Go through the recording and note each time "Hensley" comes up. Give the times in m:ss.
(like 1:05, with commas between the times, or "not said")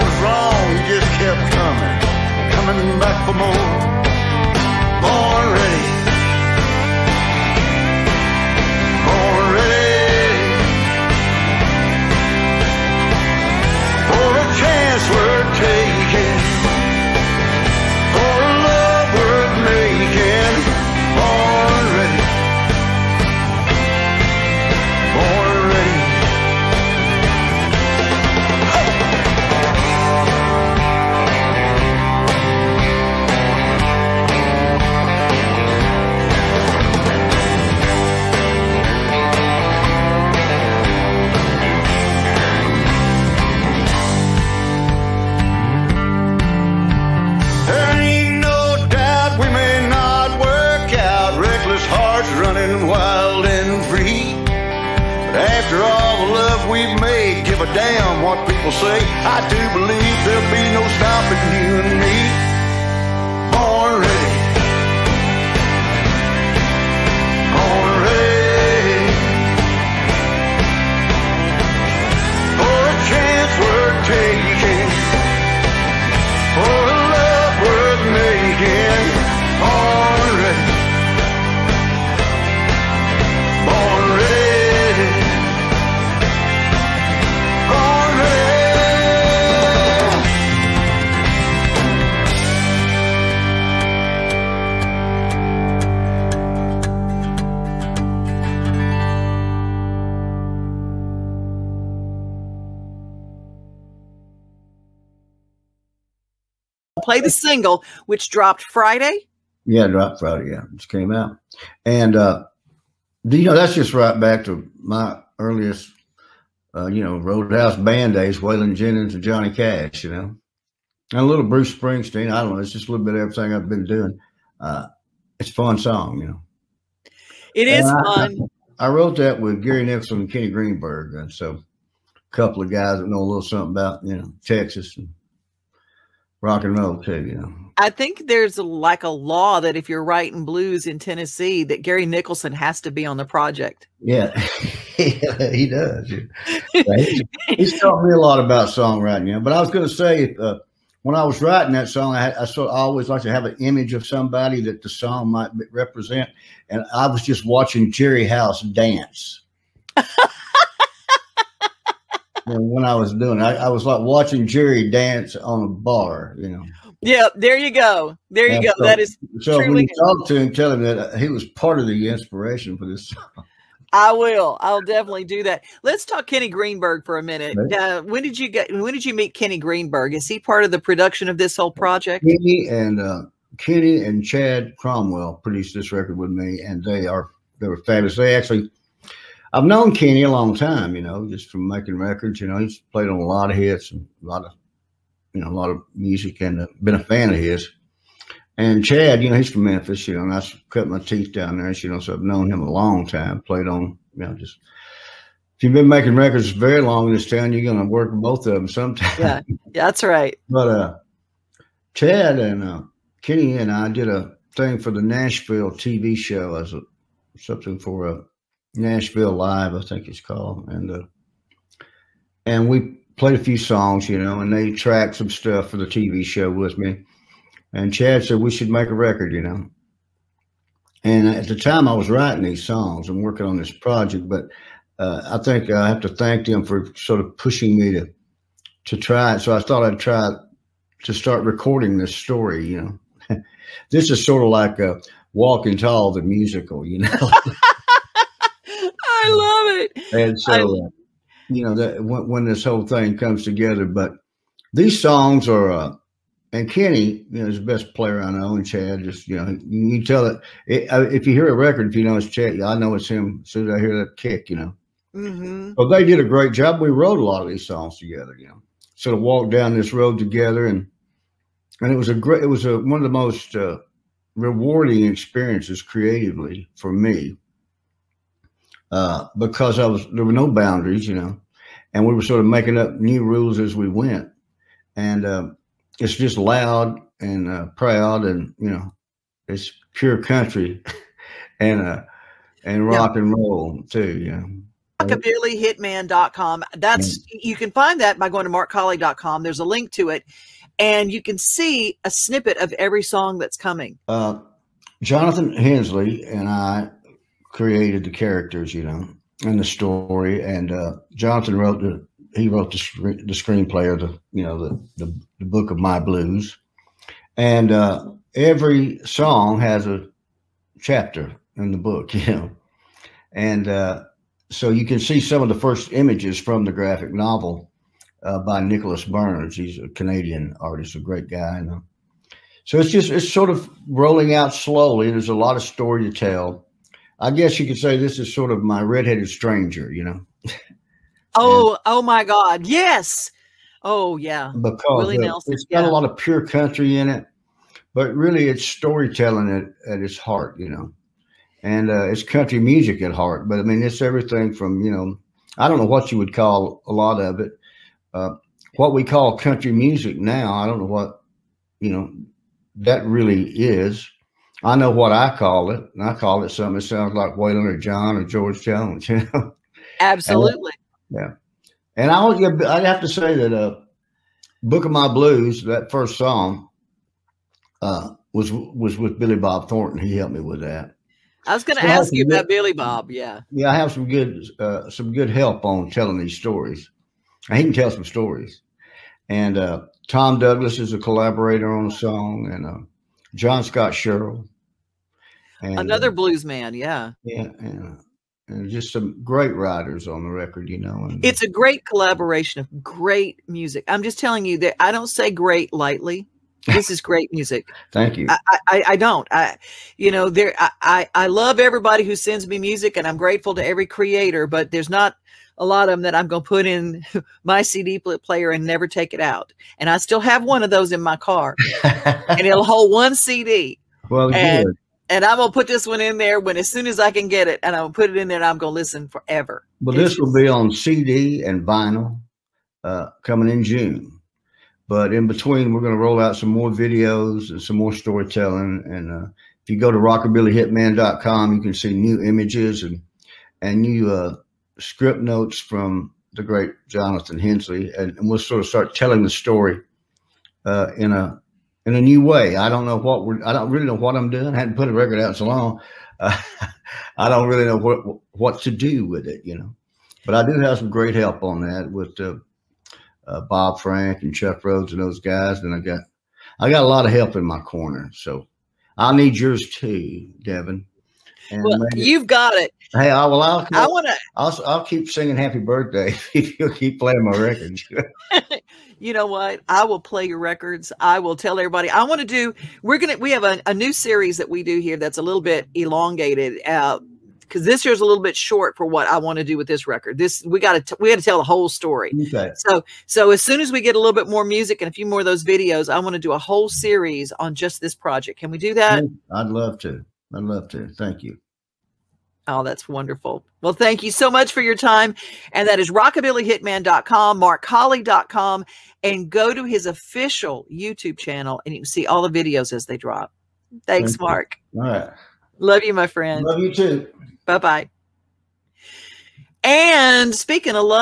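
5:05, 7:27.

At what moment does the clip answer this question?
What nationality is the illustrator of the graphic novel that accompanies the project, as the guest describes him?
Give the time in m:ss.
5:29.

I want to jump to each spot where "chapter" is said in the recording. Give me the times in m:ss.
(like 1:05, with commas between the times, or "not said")
5:20.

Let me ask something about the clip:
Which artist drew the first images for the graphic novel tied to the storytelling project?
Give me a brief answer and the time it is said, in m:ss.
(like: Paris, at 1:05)
Nicholas Burns, at 5:28.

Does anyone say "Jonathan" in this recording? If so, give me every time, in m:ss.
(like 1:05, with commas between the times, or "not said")
5:05, 7:26.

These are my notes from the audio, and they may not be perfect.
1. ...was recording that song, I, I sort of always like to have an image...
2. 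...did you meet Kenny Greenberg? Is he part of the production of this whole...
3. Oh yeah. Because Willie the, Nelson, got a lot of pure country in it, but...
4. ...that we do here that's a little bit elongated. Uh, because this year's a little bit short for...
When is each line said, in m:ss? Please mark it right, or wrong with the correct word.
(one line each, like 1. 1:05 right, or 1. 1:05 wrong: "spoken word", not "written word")
1. 2:31 wrong: "writing", not "recording"
2. 2:58 right
3. 5:43 right
4. 8:04 right.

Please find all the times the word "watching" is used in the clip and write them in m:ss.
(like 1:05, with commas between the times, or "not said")
2:37, 2:44.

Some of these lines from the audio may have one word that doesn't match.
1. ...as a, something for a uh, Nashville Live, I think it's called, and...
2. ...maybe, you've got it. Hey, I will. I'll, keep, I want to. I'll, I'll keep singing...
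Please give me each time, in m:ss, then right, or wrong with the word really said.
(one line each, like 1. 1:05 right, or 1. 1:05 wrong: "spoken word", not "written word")
1. 3:36 right
2. 7:51 right.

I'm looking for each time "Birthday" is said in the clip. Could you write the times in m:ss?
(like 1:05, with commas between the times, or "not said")
7:55.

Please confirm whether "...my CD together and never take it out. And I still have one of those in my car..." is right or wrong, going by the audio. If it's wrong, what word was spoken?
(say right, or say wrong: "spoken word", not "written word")
wrong: "player", not "together".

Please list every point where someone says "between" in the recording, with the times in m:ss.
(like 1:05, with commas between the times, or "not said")
7:15.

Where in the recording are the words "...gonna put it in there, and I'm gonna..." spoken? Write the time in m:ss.
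7:07.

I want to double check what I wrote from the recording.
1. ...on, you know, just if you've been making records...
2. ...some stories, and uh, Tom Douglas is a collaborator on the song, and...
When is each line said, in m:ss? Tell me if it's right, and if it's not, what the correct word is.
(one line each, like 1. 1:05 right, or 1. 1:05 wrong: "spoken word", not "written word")
1. 3:23 right
2. 6:27 right.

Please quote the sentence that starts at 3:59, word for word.
So I thought I'd try to start recording this story, you know.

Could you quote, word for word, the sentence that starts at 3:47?
And Chad said we should make a record, you know.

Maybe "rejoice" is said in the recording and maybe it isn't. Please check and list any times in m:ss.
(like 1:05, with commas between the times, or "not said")
not said.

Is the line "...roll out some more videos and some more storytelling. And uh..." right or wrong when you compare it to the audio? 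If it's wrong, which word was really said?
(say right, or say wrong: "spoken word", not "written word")
right.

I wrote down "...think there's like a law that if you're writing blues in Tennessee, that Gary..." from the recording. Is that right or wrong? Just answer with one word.
right.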